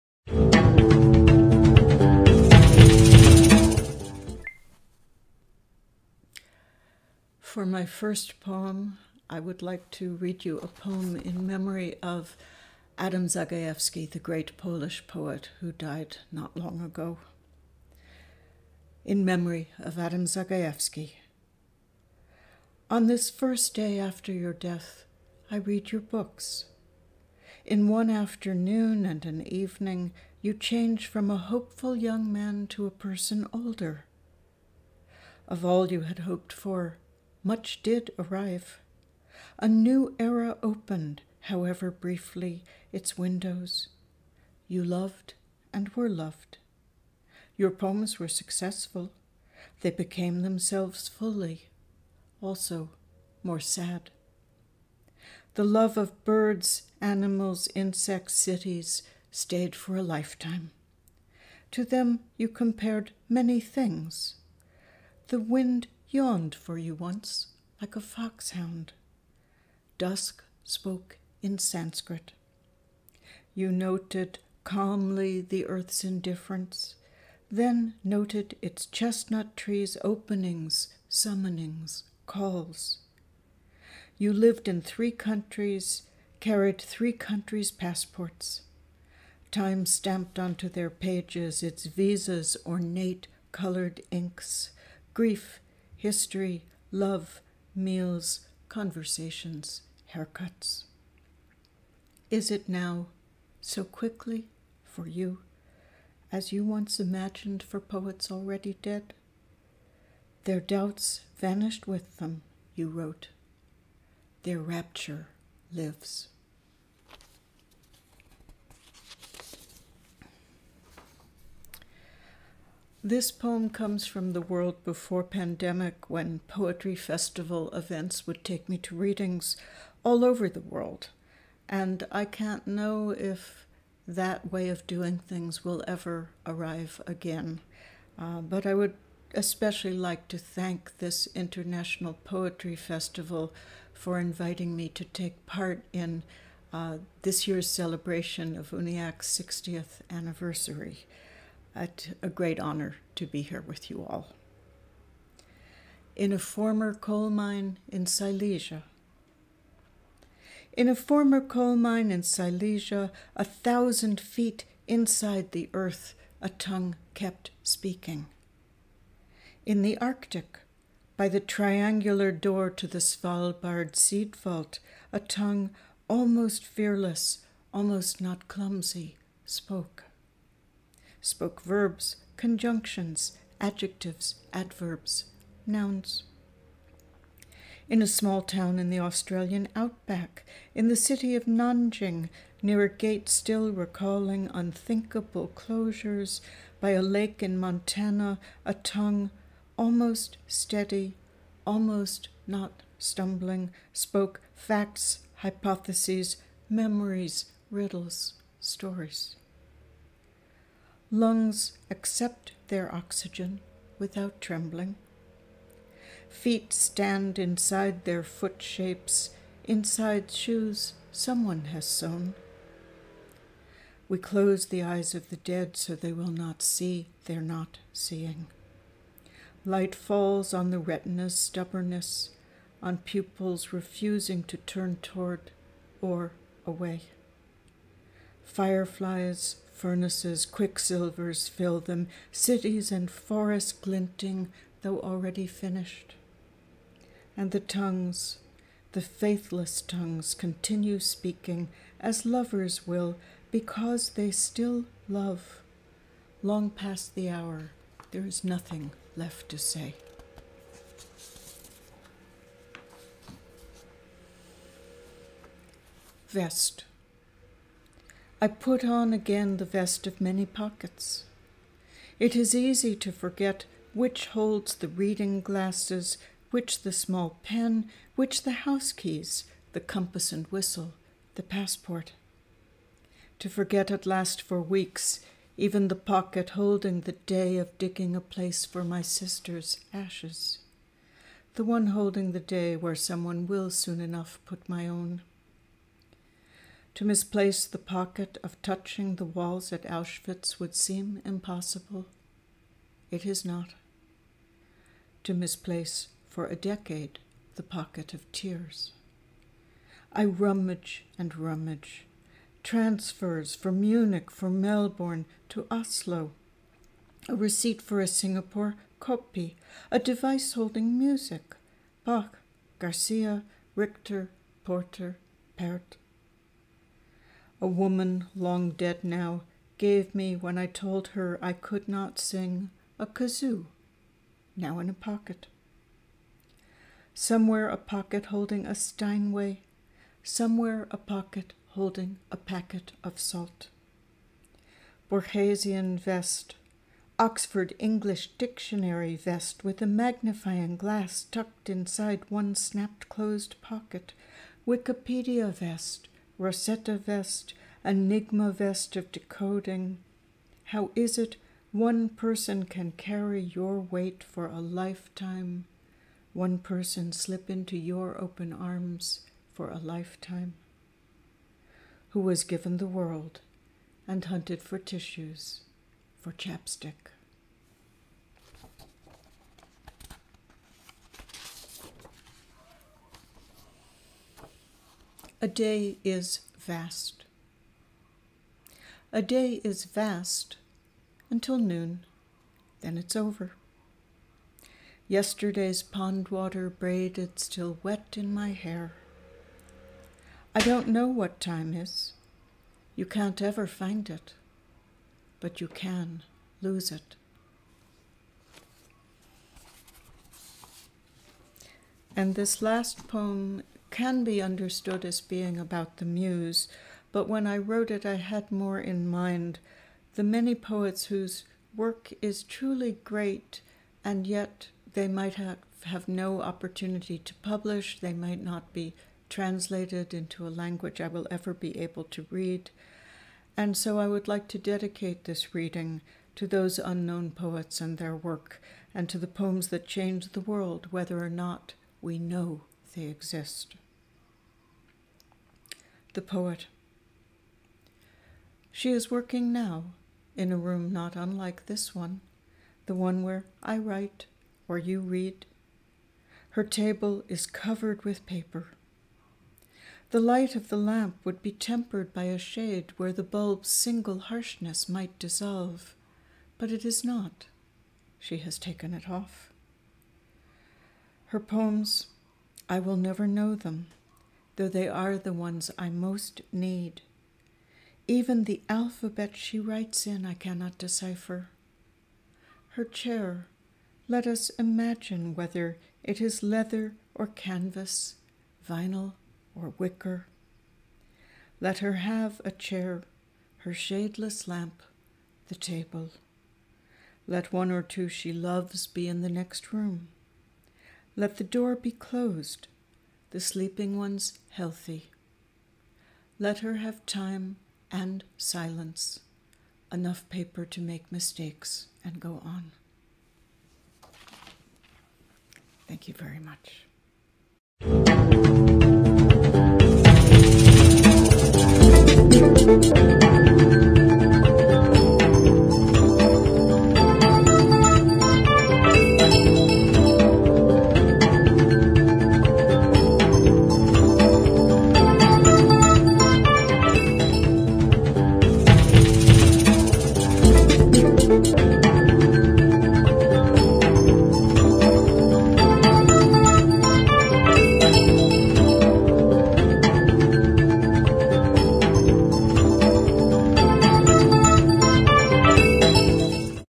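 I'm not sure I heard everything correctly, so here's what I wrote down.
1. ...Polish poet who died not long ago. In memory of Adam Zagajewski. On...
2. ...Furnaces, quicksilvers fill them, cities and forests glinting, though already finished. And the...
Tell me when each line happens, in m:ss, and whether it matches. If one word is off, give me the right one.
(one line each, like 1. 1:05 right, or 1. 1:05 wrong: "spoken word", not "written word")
1. 0:14 right
2. 3:59 right.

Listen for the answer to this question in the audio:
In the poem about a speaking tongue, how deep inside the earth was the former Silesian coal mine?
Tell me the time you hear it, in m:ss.
2:43.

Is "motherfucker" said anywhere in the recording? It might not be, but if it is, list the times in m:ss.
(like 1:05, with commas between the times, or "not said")
not said.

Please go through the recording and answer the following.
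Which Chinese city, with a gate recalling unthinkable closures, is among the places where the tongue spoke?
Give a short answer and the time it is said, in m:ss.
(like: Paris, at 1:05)
Nanjing, at 3:11.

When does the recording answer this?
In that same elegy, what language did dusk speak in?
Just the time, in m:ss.
1:11.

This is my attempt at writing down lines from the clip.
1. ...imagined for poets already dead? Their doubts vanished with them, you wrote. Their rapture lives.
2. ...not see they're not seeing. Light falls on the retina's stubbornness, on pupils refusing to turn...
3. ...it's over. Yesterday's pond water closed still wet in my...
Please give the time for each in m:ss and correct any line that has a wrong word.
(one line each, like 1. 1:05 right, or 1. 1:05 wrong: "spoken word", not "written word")
1. 1:46 right
2. 3:46 right
3. 6:32 wrong: "braided", not "closed".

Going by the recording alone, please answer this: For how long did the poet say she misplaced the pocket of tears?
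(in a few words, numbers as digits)
a decade.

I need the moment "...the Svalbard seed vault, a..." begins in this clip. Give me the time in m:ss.
2:52.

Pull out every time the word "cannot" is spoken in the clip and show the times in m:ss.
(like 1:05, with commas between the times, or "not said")
8:00.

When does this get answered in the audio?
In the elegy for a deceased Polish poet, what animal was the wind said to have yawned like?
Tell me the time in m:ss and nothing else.
1:07.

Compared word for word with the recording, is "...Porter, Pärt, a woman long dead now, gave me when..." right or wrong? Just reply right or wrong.
right.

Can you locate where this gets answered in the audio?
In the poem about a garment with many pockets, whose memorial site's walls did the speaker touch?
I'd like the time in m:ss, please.
4:59.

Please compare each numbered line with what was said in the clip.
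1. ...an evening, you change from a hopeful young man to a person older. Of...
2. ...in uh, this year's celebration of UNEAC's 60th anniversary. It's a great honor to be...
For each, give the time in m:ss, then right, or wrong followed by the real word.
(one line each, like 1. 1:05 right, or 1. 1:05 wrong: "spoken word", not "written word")
1. 0:29 right
2. 2:25 right.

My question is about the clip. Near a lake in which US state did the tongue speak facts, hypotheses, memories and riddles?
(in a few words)
Montana.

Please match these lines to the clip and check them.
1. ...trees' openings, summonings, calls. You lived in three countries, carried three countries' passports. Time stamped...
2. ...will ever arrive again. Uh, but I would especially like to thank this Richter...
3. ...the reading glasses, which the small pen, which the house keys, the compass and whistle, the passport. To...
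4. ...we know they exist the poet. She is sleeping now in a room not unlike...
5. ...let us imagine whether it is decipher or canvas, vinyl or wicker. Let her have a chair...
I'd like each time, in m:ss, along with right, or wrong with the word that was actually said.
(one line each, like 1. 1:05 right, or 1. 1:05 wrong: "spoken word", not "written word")
1. 1:19 right
2. 2:15 wrong: "International", not "Richter"
3. 4:34 right
4. 7:22 wrong: "working", not "sleeping"
5. 8:04 wrong: "leather", not "decipher".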